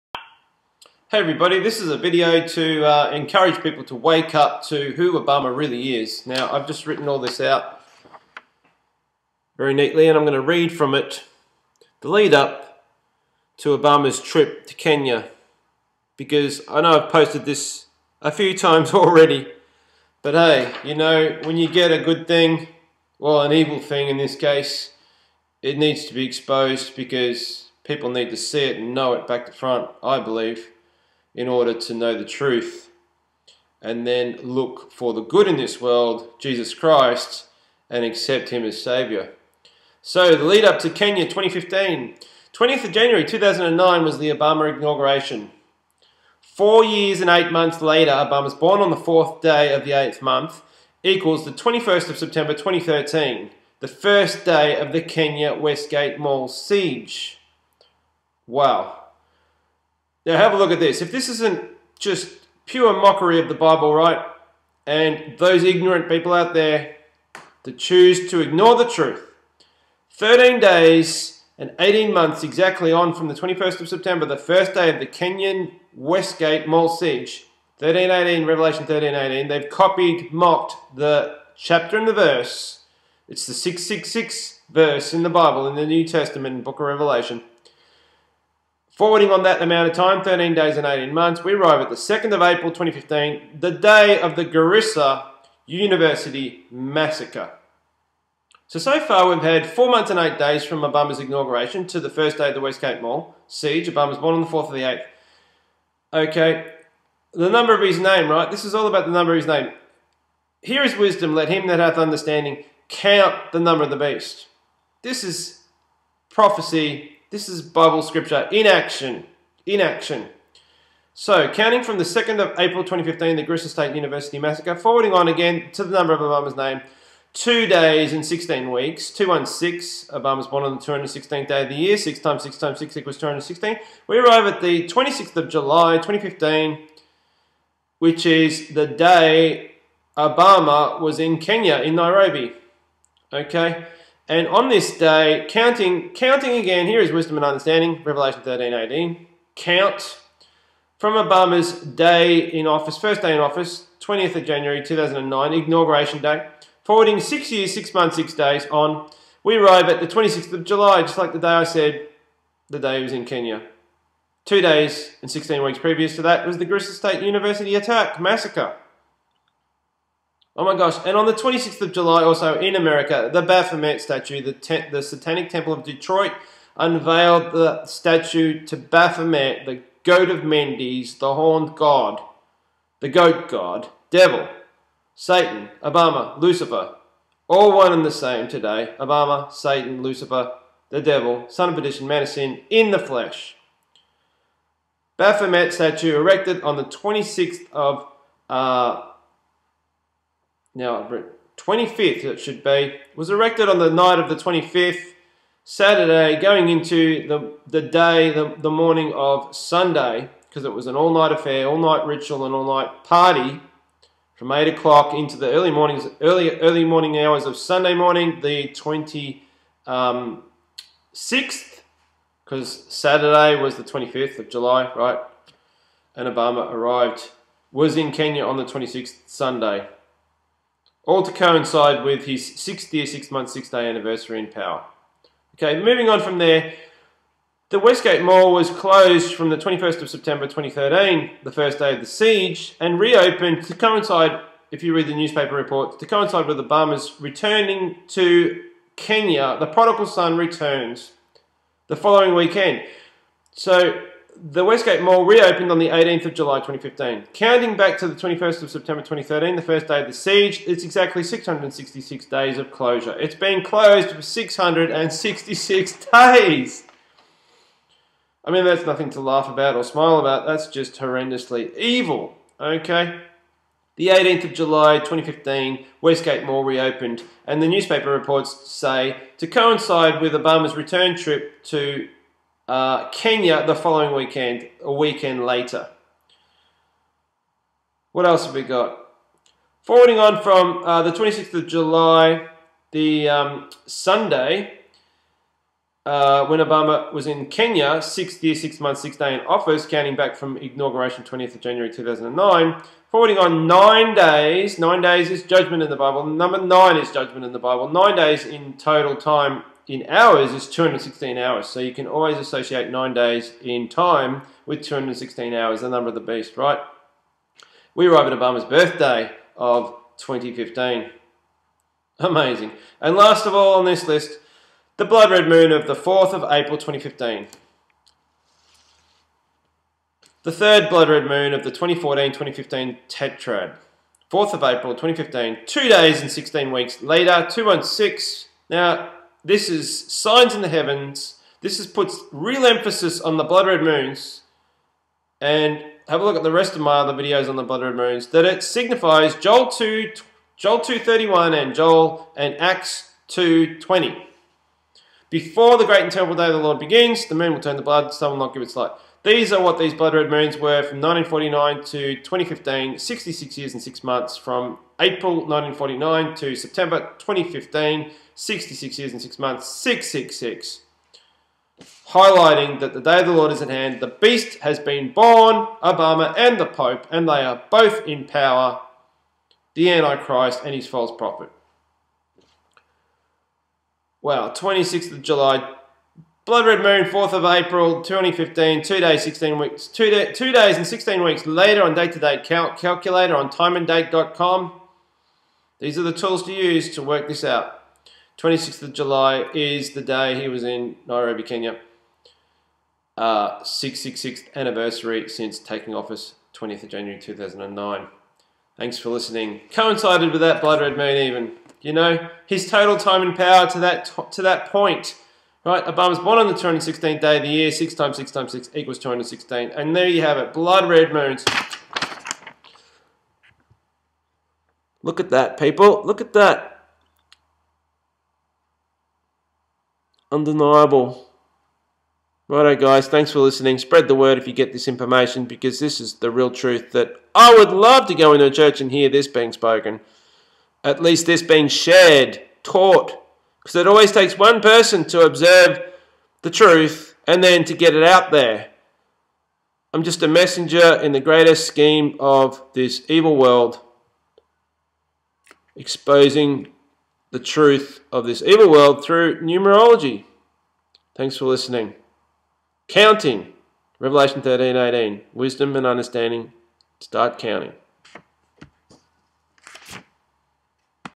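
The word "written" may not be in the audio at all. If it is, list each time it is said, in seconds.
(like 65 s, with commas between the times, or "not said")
6 s.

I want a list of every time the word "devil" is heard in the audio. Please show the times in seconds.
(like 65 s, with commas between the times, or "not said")
184 s, 191 s.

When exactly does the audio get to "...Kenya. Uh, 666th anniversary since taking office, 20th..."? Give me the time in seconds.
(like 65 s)
401 s.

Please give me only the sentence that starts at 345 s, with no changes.
And have a look at the rest of my other videos on the blood red moons.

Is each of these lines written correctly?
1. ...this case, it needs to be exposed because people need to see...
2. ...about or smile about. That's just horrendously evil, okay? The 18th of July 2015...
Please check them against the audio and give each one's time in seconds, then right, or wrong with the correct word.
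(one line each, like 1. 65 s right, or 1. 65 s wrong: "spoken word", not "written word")
1. 24 s right
2. 269 s right.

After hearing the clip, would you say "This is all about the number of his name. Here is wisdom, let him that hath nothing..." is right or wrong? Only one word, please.
wrong.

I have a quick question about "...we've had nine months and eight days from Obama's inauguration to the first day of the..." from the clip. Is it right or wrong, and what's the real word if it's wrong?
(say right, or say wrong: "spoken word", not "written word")
wrong: "four", not "nine".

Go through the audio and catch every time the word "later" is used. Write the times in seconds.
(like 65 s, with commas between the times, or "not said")
47 s, 285 s, 337 s, 391 s.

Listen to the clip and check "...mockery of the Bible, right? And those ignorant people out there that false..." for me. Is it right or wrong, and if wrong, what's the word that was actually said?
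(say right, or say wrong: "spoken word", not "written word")
wrong: "choose", not "false".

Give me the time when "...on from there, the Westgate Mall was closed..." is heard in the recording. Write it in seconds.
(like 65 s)
236 s.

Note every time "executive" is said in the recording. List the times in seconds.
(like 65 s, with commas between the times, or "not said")
not said.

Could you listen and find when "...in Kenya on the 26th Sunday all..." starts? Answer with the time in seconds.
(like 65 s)
227 s.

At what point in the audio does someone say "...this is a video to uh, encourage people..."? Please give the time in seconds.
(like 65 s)
1 s.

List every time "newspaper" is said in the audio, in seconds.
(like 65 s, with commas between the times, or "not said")
245 s, 277 s.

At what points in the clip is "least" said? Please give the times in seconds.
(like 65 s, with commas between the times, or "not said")
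441 s.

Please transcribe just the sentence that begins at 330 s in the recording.
The third blood red moon of the 2014-2015 tetrad.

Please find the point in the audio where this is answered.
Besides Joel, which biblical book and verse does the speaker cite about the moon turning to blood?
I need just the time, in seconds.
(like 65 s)
352 s.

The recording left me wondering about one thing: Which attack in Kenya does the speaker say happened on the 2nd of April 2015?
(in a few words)
Garissa University massacre.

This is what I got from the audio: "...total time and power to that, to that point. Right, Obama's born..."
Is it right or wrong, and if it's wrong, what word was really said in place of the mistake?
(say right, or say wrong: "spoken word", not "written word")
right.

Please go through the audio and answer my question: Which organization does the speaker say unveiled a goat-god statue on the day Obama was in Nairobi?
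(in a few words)
Satanic Temple of Detroit.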